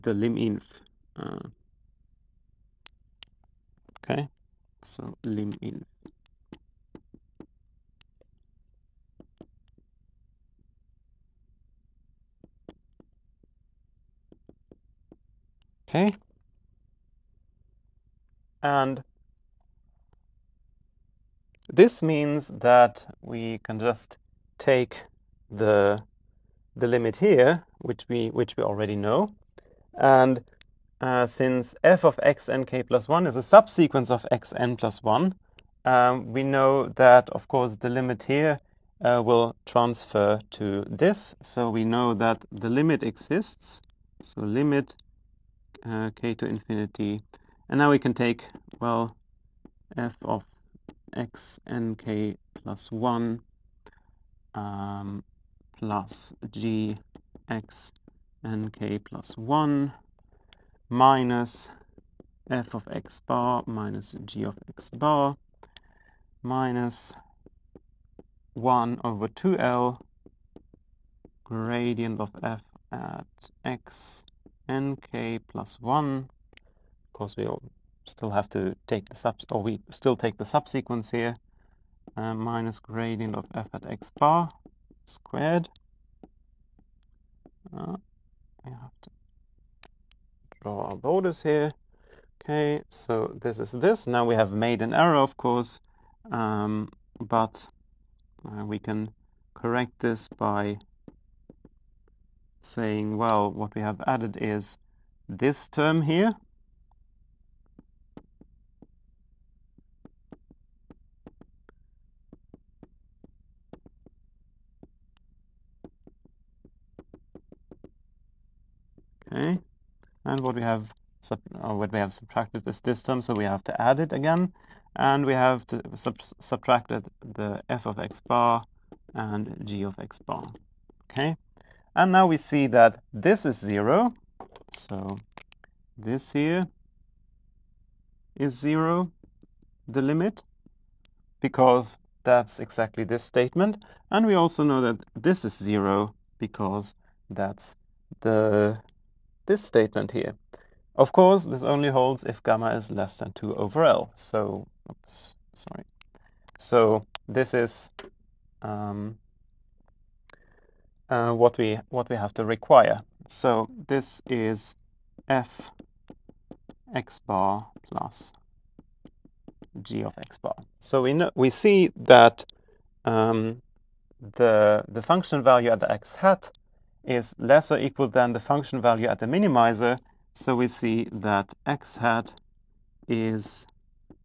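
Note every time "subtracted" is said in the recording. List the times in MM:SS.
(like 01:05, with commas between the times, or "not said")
02:02, 02:06.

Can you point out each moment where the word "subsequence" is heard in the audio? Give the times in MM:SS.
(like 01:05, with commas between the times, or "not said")
00:33, 01:20.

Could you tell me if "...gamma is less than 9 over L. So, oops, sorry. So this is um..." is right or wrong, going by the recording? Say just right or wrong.
wrong.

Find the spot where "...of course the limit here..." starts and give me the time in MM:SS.
00:37.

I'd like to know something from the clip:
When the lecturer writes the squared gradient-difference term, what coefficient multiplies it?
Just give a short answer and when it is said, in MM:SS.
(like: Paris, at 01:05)
1/(2L), at 01:08.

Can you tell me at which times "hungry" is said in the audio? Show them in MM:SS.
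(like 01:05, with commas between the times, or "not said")
not said.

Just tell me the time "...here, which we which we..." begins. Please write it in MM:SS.
00:27.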